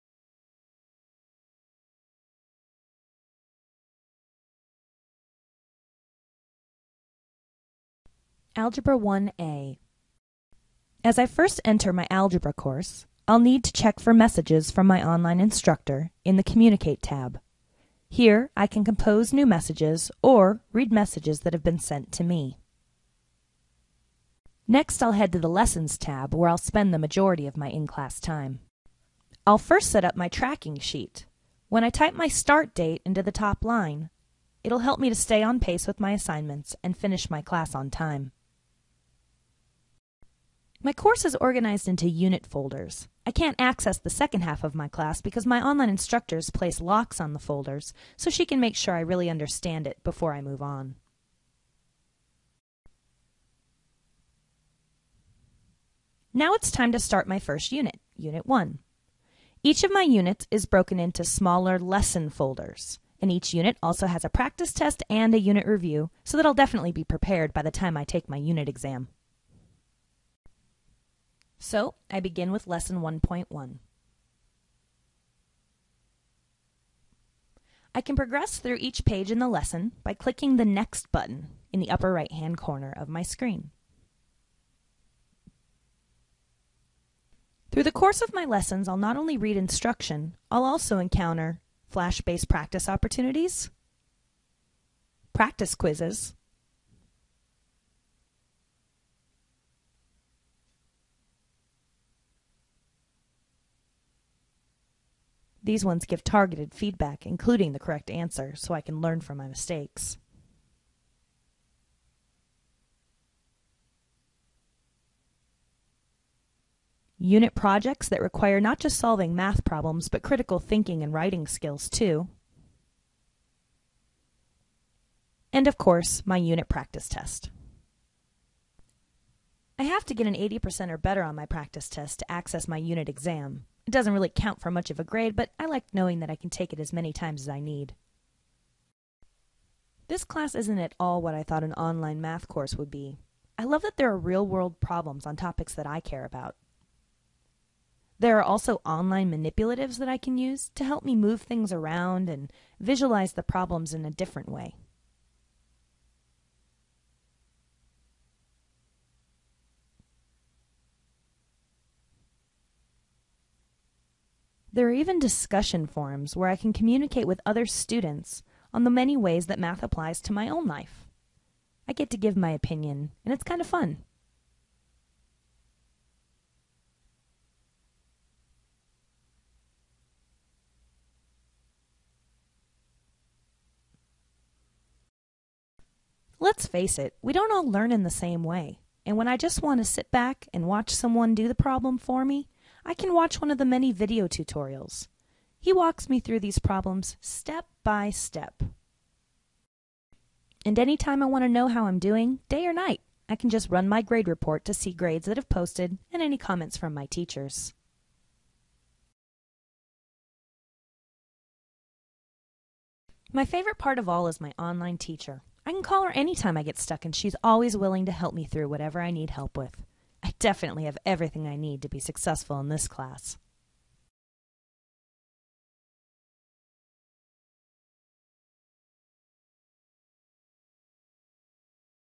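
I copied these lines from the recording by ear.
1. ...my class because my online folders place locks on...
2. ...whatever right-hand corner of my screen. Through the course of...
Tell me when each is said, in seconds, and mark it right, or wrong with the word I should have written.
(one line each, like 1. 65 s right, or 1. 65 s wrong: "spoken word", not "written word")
1. 44 s wrong: "instructors", not "folders"
2. 81 s wrong: "upper", not "whatever".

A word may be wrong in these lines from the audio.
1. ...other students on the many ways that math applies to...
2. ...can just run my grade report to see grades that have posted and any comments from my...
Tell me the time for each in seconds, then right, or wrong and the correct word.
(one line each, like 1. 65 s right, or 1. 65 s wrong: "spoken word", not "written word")
1. 167 s right
2. 203 s right.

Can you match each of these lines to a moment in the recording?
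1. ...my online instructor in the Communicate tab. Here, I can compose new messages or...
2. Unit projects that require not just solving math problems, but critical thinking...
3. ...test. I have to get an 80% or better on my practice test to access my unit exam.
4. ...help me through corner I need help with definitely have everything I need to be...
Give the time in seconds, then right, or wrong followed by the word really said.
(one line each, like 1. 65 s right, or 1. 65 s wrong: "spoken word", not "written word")
1. 14 s right
2. 117 s right
3. 127 s right
4. 218 s wrong: "whatever", not "corner".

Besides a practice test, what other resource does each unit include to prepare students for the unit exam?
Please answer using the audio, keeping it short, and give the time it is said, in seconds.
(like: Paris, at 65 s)
unit review, at 65 s.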